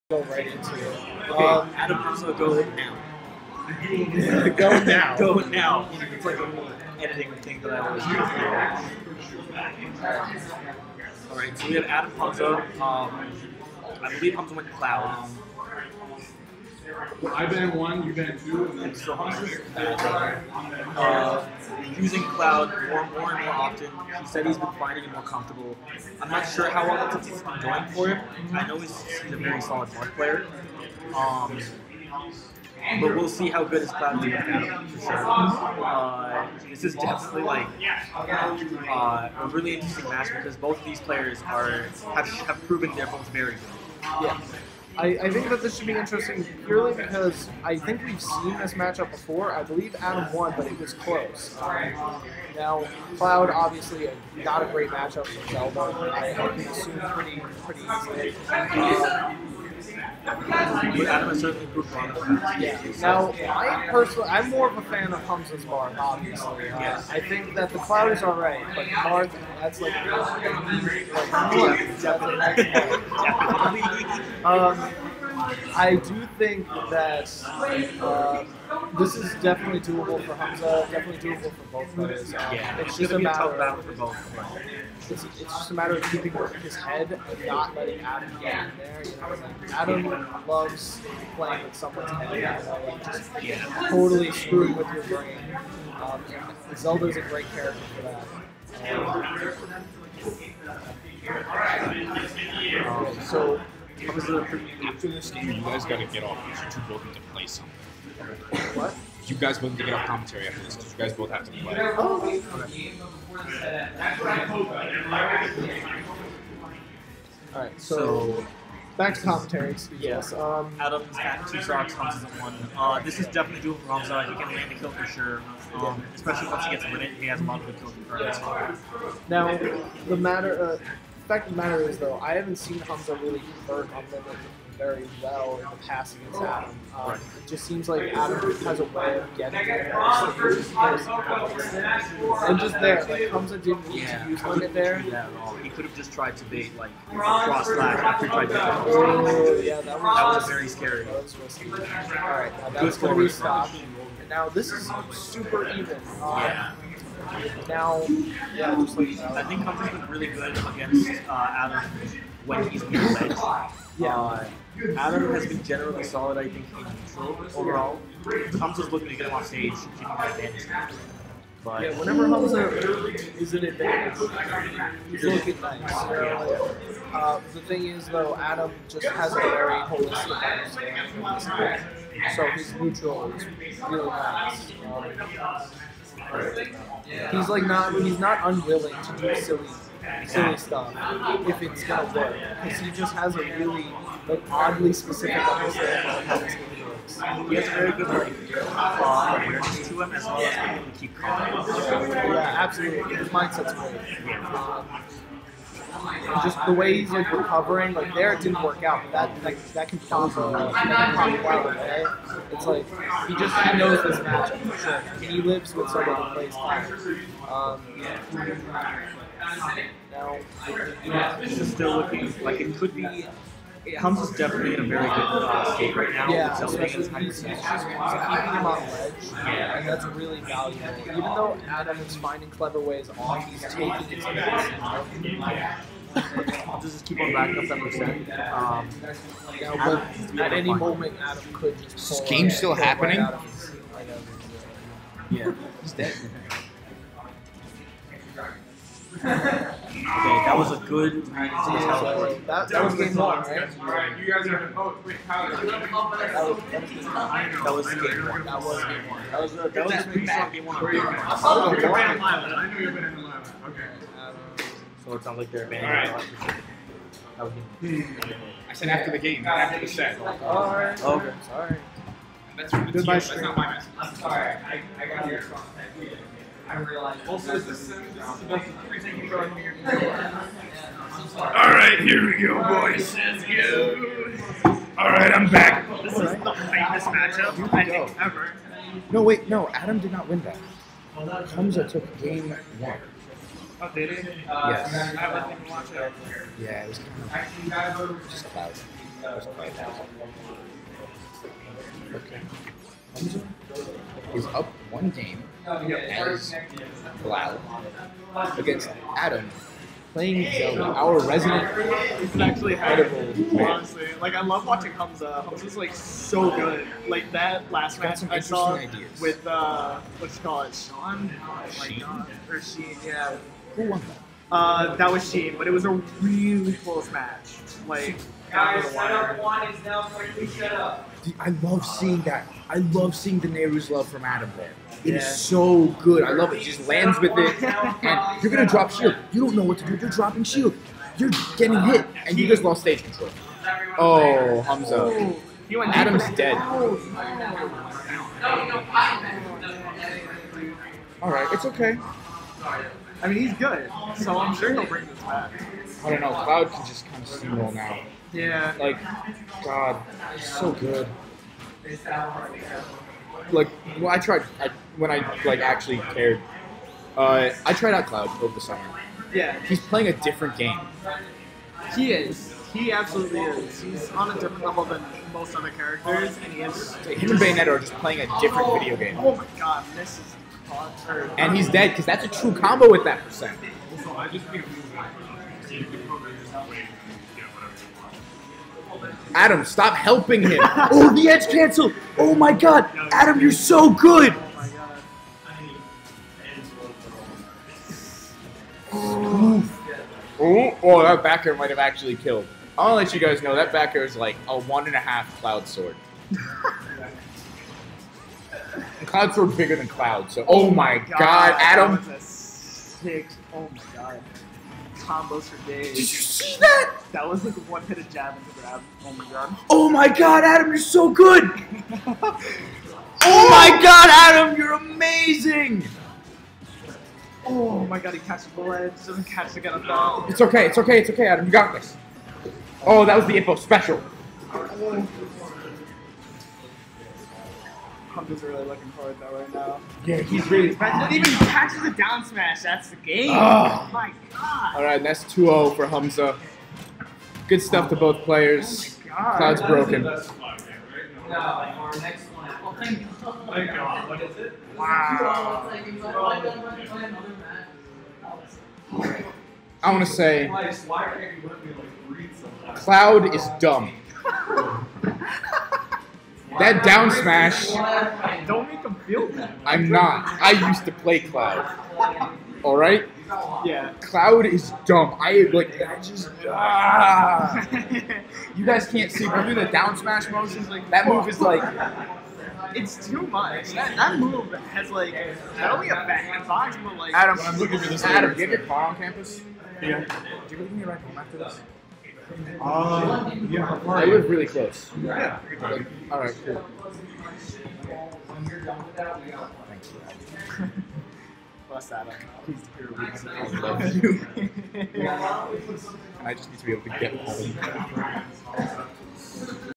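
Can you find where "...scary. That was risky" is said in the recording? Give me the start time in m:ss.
2:30.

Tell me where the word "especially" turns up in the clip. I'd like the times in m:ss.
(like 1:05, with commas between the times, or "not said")
2:06, 3:46.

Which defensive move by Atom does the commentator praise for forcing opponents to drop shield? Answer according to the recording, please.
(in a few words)
Nayru's Love.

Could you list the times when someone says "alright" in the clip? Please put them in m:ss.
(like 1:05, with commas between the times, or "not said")
0:11, 1:08, 4:36, 4:44.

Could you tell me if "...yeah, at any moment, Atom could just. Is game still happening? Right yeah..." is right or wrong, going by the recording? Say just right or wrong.
right.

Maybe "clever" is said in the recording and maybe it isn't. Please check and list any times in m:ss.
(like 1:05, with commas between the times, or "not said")
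3:52.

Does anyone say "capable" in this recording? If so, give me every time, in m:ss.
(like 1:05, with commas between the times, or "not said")
not said.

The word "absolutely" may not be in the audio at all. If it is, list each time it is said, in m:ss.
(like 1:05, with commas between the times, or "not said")
3:22, 6:12.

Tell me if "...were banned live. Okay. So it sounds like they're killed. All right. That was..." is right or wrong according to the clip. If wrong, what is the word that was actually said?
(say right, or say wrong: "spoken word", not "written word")
wrong: "banned", not "killed".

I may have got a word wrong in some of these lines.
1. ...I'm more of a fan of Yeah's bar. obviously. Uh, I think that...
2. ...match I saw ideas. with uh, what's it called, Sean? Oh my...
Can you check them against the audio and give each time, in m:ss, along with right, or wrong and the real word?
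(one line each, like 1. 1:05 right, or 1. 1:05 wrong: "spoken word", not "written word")
1. 1:04 wrong: "Humza", not "Yeah"
2. 5:17 right.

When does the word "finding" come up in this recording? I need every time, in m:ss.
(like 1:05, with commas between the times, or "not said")
0:24, 3:52.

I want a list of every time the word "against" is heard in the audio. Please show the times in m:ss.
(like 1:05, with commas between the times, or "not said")
2:16, 2:40, 5:08.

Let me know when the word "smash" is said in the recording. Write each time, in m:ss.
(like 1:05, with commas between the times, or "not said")
7:22, 7:47, 7:59.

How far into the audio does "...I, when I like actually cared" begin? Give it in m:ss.
6:04.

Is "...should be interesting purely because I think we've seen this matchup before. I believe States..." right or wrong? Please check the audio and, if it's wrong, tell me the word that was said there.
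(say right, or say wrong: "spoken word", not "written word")
wrong: "Atom", not "States".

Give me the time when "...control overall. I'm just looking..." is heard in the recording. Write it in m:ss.
2:46.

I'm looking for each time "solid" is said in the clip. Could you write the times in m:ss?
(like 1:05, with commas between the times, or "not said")
0:29, 2:46.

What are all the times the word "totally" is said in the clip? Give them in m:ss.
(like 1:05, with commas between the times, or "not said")
1:33.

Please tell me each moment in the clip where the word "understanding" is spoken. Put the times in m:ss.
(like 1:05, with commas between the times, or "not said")
3:00, 3:15.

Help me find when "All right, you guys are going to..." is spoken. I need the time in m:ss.
4:13.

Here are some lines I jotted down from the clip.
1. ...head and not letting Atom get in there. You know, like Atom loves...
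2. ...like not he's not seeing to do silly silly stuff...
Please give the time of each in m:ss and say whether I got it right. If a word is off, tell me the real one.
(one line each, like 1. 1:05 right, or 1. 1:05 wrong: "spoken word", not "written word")
1. 1:26 right
2. 3:07 wrong: "unwilling", not "seeing".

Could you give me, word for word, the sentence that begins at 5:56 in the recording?
Cloud can just kind of steamroll now.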